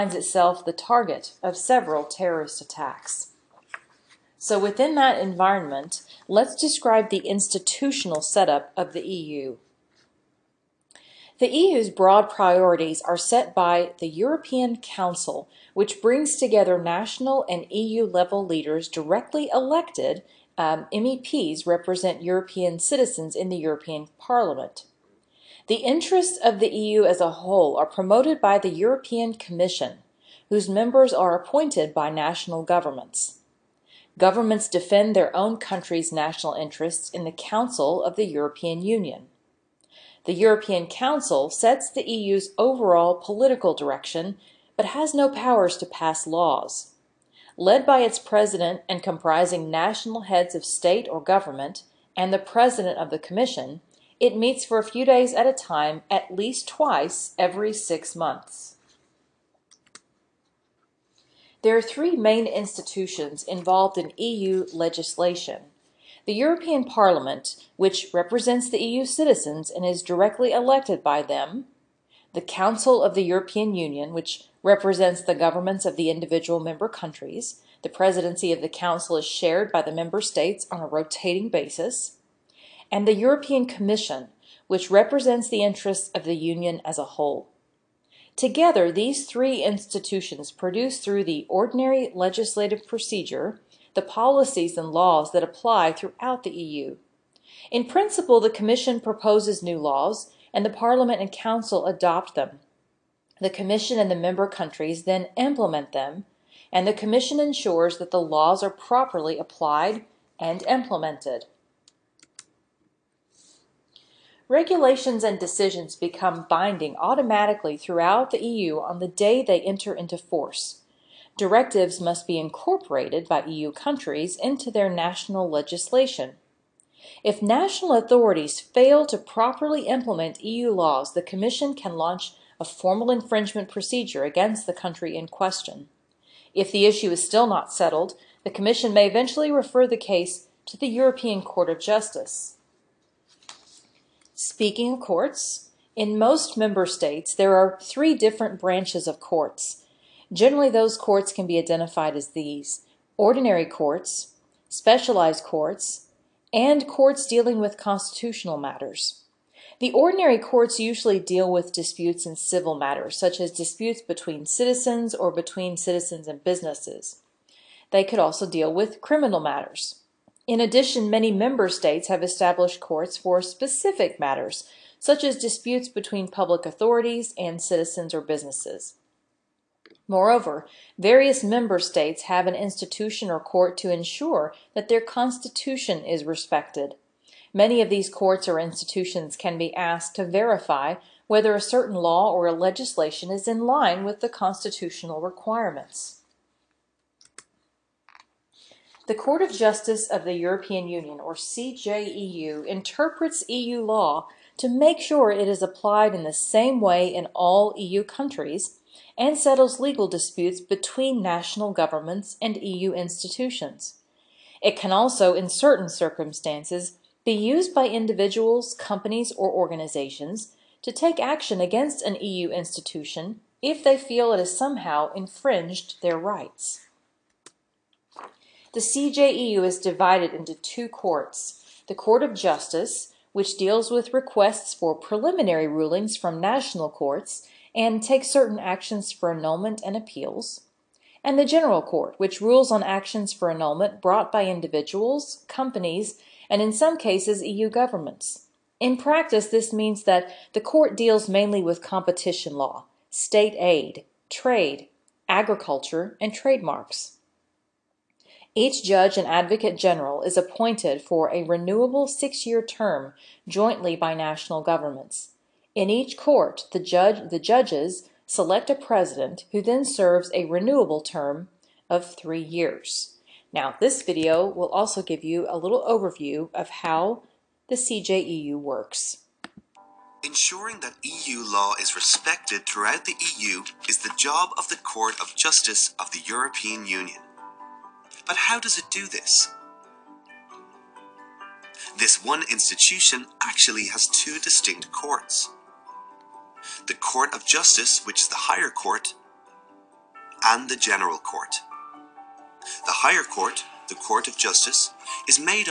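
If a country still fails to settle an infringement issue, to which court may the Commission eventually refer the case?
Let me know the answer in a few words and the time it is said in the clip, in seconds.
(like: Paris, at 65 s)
European Court of Justice, at 140 s.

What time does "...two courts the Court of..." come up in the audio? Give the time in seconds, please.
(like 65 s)
230 s.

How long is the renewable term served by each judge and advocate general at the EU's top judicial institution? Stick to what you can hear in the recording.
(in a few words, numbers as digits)
6 years.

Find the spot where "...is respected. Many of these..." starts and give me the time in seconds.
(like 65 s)
186 s.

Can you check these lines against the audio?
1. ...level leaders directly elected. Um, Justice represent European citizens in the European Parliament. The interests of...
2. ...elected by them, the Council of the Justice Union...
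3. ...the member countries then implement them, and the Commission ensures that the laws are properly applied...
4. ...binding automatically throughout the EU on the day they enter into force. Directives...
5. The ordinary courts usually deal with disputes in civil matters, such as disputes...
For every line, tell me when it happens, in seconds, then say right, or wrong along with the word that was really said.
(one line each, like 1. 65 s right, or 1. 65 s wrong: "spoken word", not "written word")
1. 18 s wrong: "MEPs", not "Justice"
2. 70 s wrong: "European", not "Justice"
3. 104 s right
4. 116 s right
5. 159 s right.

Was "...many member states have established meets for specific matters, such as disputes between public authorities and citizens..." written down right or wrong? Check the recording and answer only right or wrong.
wrong.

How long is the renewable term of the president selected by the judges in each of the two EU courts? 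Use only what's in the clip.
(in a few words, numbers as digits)
3 years.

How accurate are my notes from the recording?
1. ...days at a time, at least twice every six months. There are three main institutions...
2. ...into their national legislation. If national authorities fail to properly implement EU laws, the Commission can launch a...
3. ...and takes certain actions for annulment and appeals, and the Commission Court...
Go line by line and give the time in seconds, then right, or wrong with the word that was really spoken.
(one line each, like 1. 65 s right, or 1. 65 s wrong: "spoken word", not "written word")
1. 55 s right
2. 124 s right
3. 237 s wrong: "General", not "Commission".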